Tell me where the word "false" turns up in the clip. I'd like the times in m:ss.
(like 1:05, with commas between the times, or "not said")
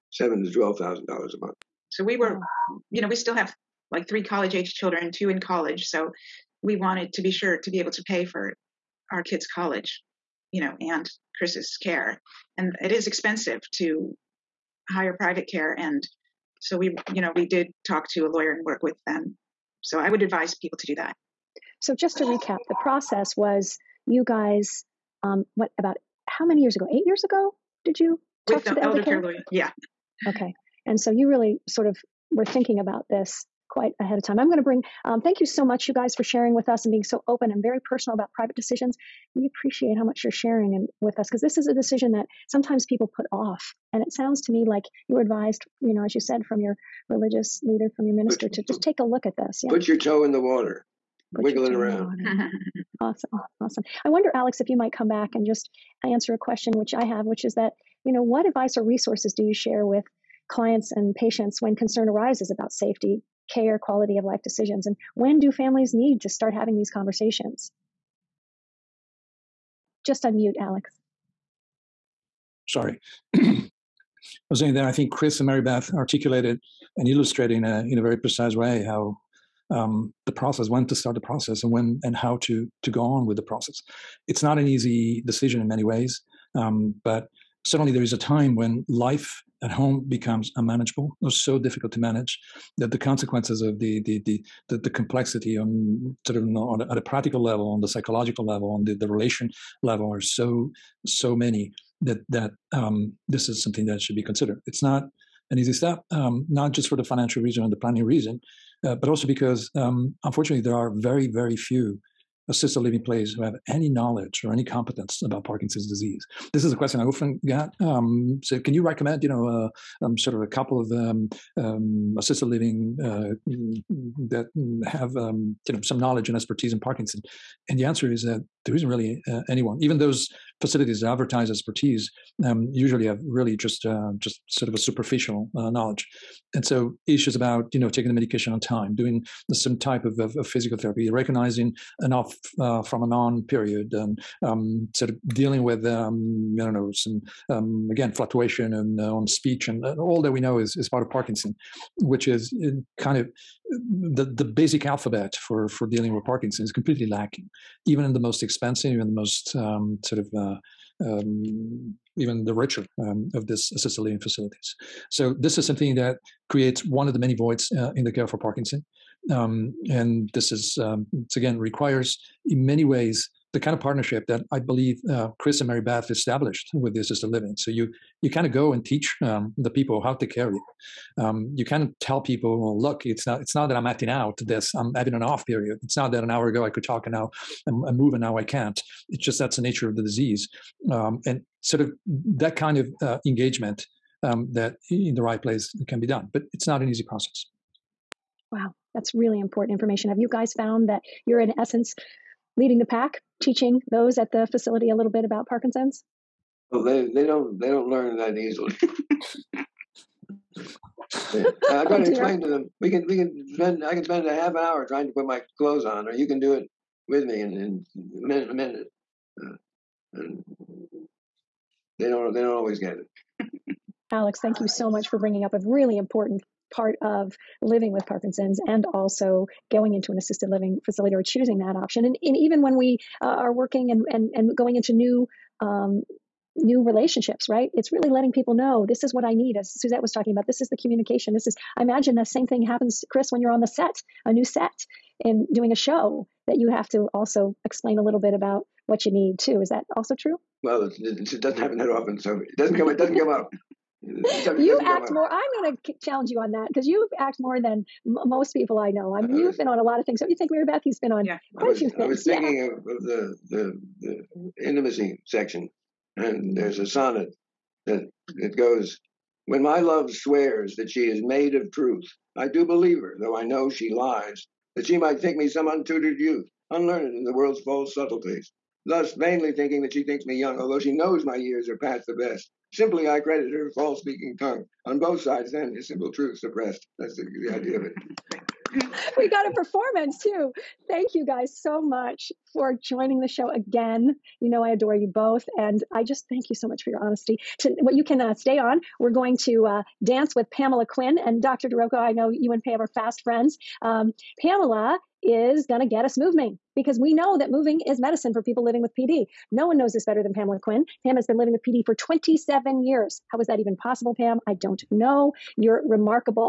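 4:37, 4:43.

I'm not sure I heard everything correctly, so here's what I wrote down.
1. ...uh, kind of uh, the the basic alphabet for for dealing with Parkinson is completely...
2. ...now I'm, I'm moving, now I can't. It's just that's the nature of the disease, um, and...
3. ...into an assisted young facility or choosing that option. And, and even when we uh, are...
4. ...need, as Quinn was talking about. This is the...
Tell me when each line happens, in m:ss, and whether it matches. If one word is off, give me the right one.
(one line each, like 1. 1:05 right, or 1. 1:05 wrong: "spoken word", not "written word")
1. 2:32 right
2. 3:07 right
3. 3:49 wrong: "living", not "young"
4. 3:59 wrong: "Suzette", not "Quinn".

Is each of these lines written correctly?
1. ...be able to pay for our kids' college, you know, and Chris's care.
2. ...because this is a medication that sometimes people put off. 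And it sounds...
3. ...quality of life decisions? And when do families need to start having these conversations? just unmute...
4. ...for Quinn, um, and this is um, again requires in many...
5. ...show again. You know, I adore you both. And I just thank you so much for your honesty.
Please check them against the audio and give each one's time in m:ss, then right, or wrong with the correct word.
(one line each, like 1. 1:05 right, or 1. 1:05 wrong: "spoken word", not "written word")
1. 0:07 right
2. 0:41 wrong: "decision", not "medication"
3. 1:03 right
4. 2:48 wrong: "Parkinson", not "Quinn"
5. 4:53 right.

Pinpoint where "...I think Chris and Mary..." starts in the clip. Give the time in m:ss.
1:14.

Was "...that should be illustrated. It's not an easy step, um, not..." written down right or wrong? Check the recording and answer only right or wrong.
wrong.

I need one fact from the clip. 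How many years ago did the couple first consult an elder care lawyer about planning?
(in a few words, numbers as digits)
8.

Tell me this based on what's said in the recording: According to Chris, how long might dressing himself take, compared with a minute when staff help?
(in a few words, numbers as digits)
half an hour.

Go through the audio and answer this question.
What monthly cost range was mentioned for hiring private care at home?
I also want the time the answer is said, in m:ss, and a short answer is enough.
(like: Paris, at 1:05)
$7,000 to $12,000, at 0:00.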